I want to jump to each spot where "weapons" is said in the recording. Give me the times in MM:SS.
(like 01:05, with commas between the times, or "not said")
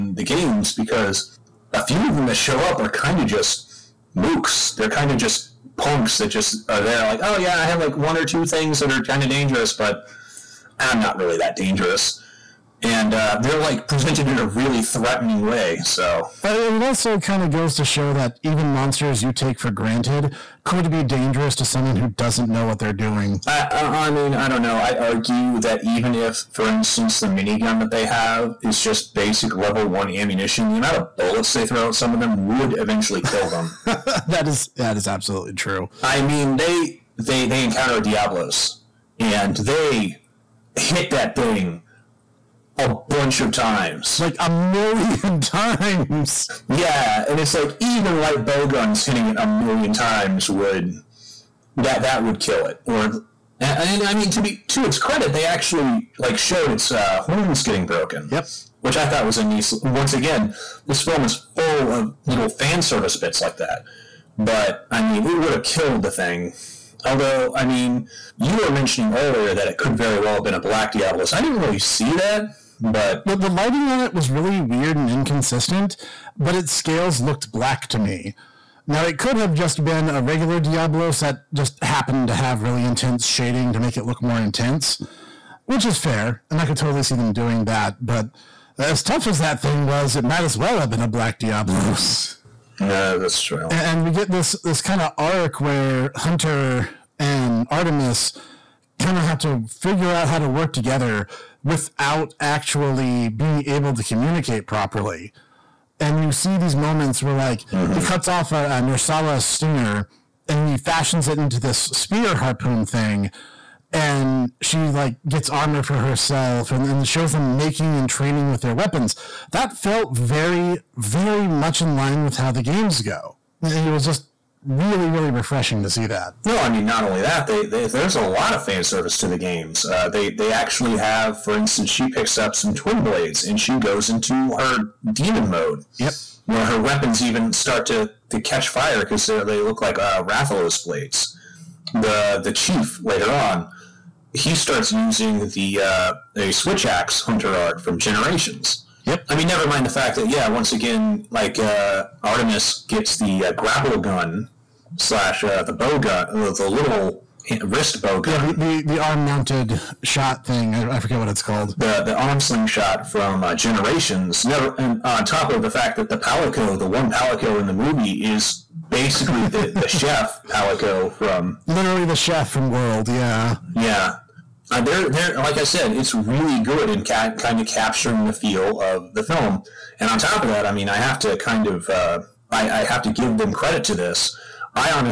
01:58, 02:16.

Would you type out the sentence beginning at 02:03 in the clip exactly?
It was just really, really refreshing to see that.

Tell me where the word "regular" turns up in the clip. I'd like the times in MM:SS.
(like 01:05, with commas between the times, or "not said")
01:20.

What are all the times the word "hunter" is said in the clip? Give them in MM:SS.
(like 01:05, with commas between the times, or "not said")
01:36, 02:27.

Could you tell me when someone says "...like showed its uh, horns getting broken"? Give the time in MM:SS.
00:56.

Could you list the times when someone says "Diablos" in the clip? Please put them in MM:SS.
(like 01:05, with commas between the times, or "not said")
00:38, 01:10, 01:20, 01:31.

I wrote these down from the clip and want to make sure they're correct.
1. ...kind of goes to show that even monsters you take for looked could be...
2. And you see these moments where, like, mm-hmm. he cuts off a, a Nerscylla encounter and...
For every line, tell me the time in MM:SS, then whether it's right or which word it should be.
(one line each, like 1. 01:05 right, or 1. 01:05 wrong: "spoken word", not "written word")
1. 00:17 wrong: "granted", not "looked"
2. 01:46 wrong: "stinger", not "encounter".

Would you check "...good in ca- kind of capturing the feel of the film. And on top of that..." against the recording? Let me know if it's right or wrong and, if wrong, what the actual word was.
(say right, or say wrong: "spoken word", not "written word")
right.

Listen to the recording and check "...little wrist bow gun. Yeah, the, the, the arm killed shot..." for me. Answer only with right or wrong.
wrong.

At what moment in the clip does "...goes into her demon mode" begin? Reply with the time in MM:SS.
02:13.